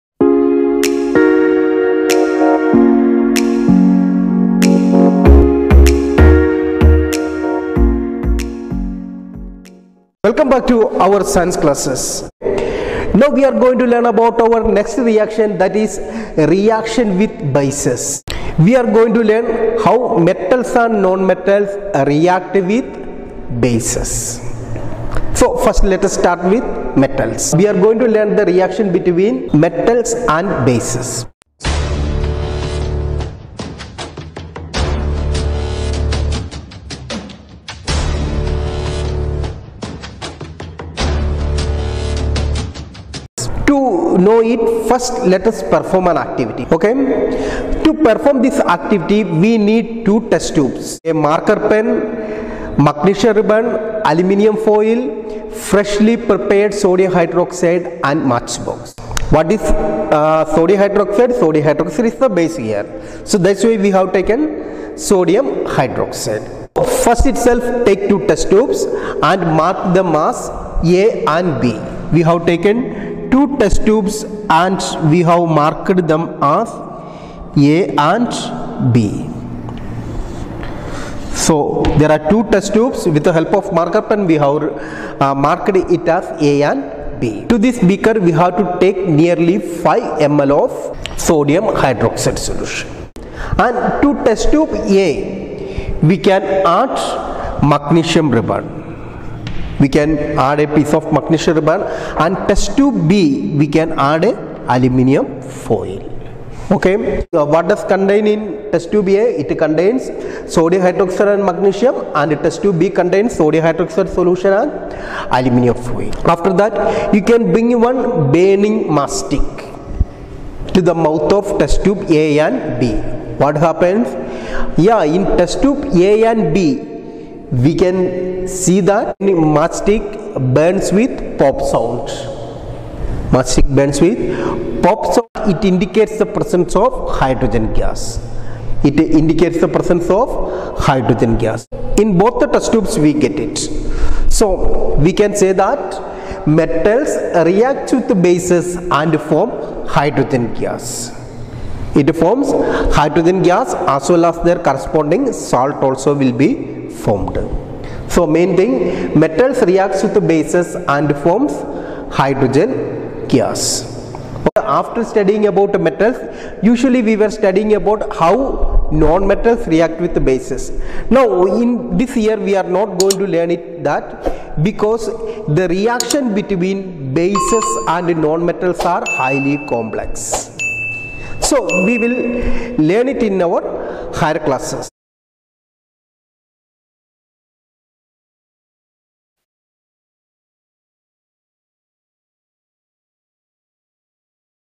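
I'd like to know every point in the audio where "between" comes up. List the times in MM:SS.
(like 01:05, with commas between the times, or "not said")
00:28, 02:56.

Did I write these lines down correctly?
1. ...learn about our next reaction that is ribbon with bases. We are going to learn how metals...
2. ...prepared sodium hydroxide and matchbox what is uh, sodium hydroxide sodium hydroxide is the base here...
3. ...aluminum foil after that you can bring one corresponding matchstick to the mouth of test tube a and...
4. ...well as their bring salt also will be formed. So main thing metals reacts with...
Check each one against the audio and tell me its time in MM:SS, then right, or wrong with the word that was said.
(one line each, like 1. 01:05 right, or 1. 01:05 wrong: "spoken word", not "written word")
1. 00:13 wrong: "reaction", not "ribbon"
2. 00:56 right
3. 01:55 wrong: "burning", not "corresponding"
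4. 02:34 wrong: "corresponding", not "bring".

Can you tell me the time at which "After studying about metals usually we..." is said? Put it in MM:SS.
02:44.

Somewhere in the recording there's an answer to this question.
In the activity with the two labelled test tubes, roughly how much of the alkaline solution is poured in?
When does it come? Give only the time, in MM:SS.
01:29.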